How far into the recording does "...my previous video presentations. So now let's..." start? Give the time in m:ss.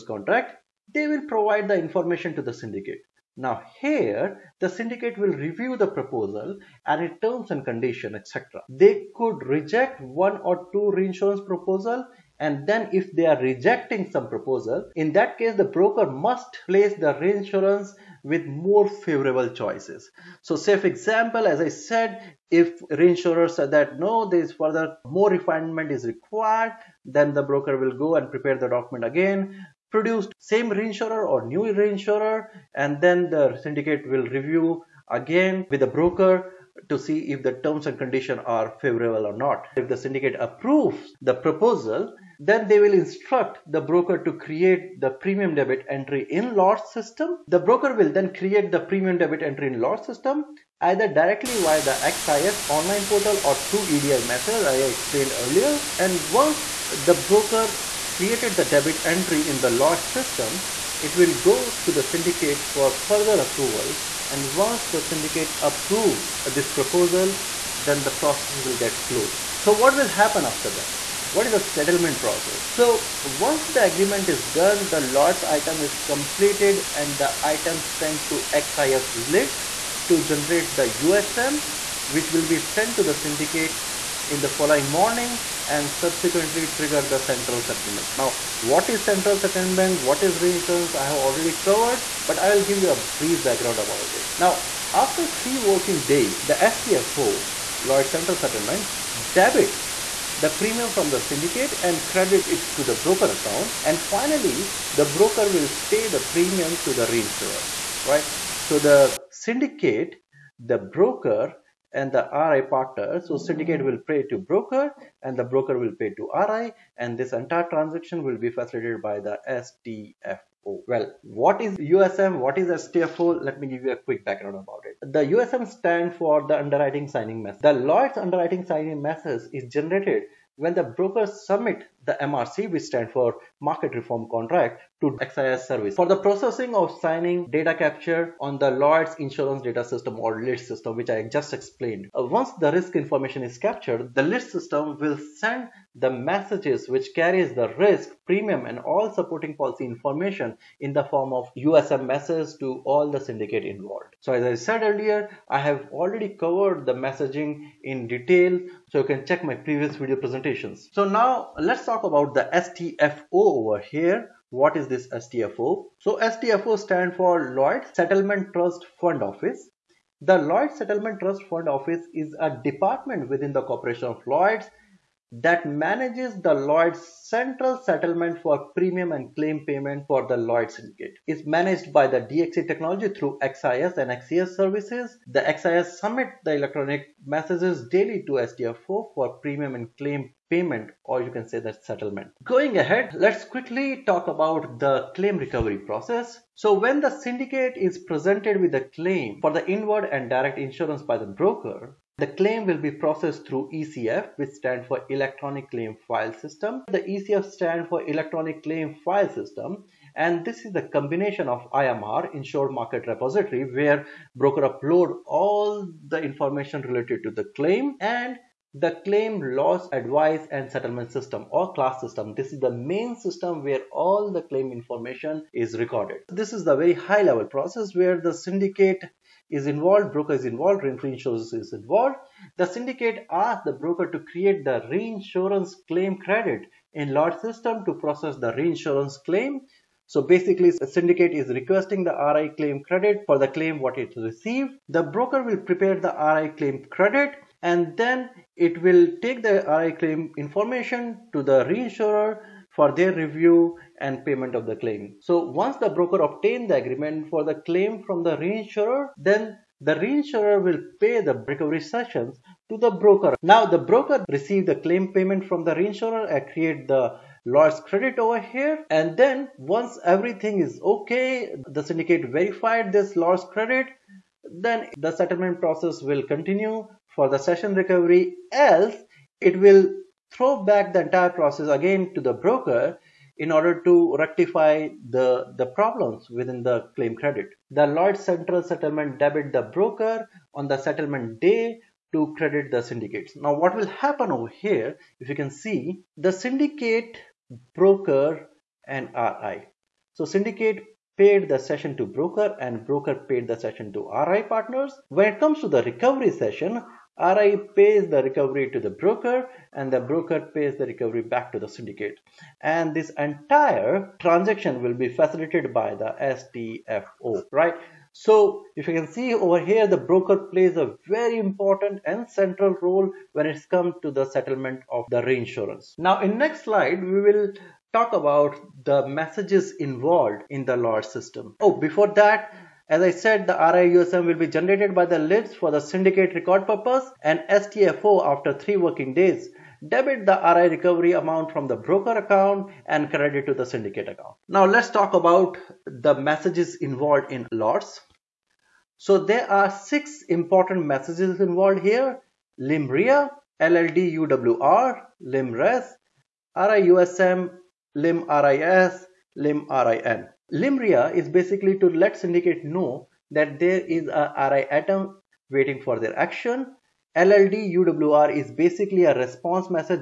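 2:39.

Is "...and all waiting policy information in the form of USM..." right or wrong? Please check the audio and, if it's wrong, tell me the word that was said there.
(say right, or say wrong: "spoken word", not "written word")
wrong: "supporting", not "waiting".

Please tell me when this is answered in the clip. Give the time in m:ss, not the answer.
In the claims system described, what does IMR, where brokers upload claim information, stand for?
3:32.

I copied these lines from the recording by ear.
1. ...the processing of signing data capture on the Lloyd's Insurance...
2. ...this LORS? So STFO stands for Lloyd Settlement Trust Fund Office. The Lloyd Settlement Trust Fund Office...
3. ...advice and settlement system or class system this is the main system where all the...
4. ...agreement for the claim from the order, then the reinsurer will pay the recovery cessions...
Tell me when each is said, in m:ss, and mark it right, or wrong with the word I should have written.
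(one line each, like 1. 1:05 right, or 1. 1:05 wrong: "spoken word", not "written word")
1. 2:16 right
2. 2:44 wrong: "STFO", not "LORS"
3. 3:39 right
4. 4:16 wrong: "reinsurer", not "order".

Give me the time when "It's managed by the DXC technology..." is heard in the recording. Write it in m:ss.
3:01.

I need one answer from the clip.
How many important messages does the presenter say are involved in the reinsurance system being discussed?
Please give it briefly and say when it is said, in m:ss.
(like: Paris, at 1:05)
6, at 5:49.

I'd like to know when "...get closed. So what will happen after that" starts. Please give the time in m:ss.
1:08.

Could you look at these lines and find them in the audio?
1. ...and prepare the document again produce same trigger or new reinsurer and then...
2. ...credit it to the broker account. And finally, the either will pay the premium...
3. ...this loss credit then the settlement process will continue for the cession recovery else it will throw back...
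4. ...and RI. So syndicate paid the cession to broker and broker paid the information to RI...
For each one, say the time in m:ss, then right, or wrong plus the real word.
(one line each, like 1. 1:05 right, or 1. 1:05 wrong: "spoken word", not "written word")
1. 0:28 wrong: "reinsurer", not "trigger"
2. 1:42 wrong: "broker", not "either"
3. 4:32 right
4. 4:58 wrong: "cession", not "information".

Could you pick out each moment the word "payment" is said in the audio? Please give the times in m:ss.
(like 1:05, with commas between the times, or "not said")
2:59, 3:10, 4:14, 4:25.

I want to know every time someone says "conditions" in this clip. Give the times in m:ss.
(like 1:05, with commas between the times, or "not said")
0:07, 0:37.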